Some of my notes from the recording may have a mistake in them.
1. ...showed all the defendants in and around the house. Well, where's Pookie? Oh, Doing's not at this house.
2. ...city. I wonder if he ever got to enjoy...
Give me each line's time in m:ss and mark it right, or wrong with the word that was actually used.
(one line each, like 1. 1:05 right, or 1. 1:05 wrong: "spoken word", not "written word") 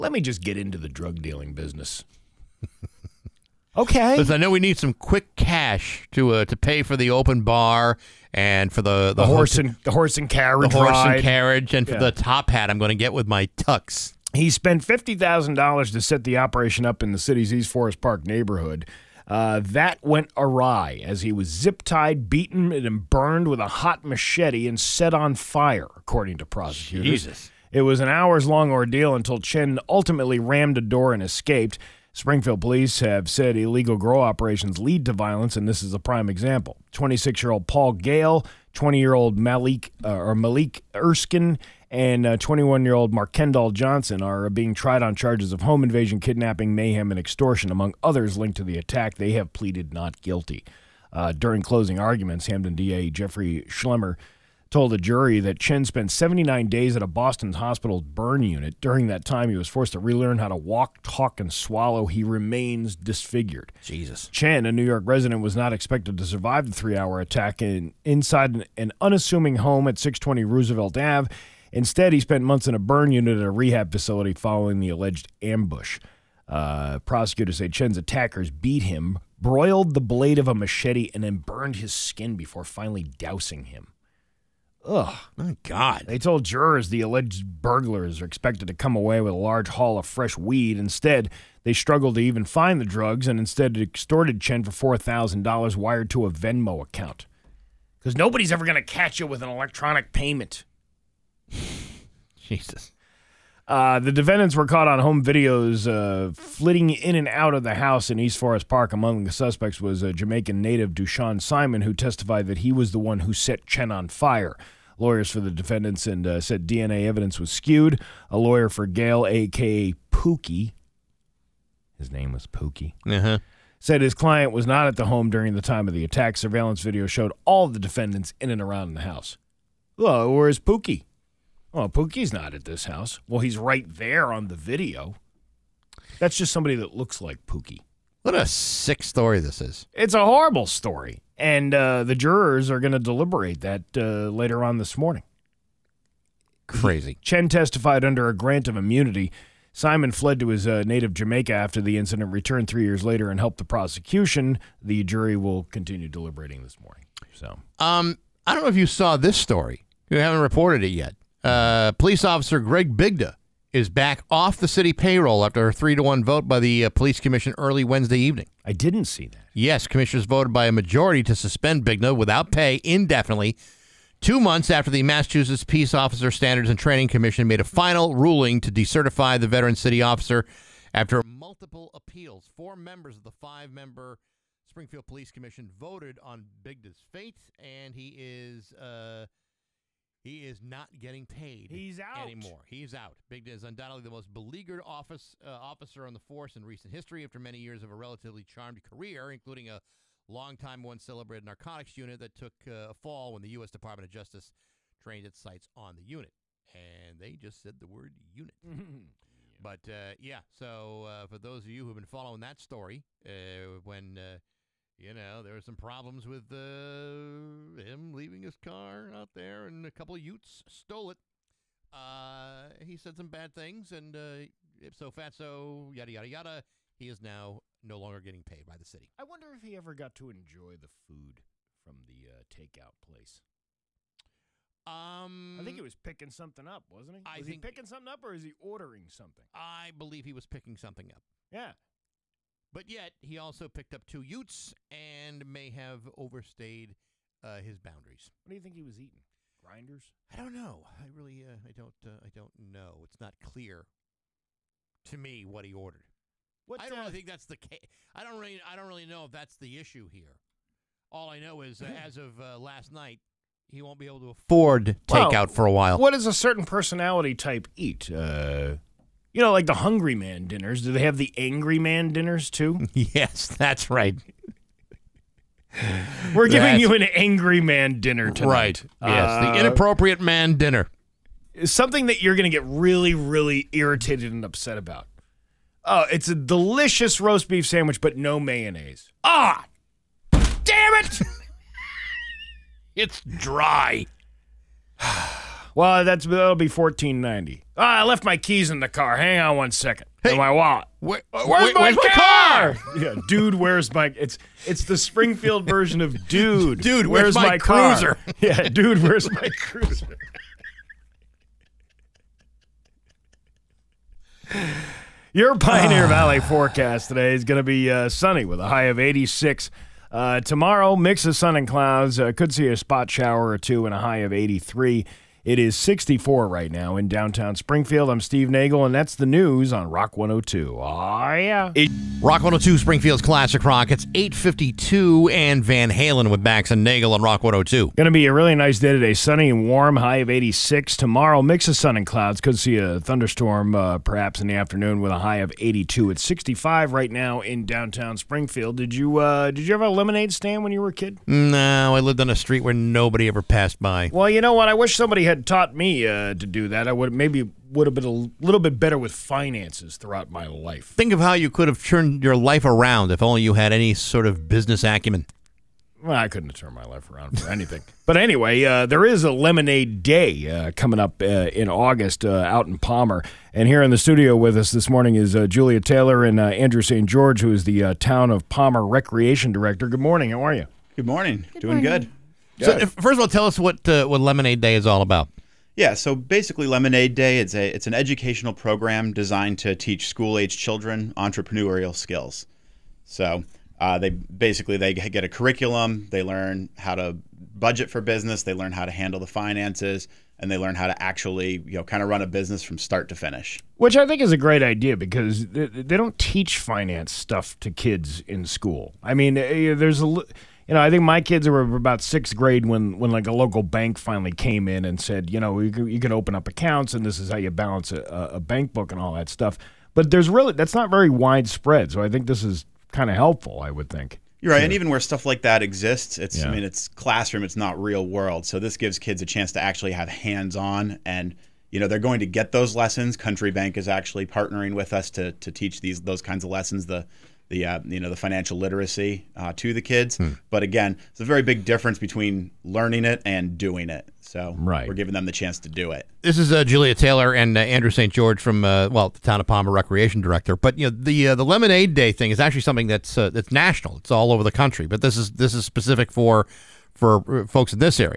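1. 2:07 wrong: "Pookie", not "Doing"
2. 3:48 right.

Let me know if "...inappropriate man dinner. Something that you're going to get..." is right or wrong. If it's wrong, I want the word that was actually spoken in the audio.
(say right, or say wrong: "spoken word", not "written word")
right.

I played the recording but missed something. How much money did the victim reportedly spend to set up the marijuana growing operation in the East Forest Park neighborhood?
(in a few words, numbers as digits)
$50,000.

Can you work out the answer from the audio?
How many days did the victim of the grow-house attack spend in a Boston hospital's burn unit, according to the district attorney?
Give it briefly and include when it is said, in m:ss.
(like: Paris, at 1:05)
79, at 0:56.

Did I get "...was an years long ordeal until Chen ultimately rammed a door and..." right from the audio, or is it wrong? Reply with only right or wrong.
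wrong.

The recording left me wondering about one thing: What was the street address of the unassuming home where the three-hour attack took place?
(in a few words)
620 Roosevelt Ave.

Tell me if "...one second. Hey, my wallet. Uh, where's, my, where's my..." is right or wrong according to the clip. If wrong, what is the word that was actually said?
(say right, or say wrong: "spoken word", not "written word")
right.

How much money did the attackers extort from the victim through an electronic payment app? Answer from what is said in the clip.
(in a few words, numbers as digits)
$4,000.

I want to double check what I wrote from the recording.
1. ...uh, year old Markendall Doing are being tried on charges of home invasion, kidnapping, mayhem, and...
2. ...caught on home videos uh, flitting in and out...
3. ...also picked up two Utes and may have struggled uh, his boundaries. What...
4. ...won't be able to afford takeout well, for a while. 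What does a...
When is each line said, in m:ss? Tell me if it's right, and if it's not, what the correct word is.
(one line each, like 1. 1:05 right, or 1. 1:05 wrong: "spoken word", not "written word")
1. 0:42 wrong: "Johnson", not "Doing"
2. 1:44 right
3. 4:03 wrong: "overstayed", not "struggled"
4. 4:23 right.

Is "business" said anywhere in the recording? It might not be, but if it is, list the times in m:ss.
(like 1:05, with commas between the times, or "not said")
0:01, 6:04, 6:38, 6:42.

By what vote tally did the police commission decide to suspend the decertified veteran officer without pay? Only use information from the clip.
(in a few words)
3 to 1.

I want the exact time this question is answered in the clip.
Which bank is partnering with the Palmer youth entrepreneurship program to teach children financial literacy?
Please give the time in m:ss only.
7:13.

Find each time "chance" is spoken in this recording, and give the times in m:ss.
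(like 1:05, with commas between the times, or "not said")
7:09, 7:25.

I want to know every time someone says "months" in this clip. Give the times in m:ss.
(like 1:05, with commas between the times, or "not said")
1:12, 2:54.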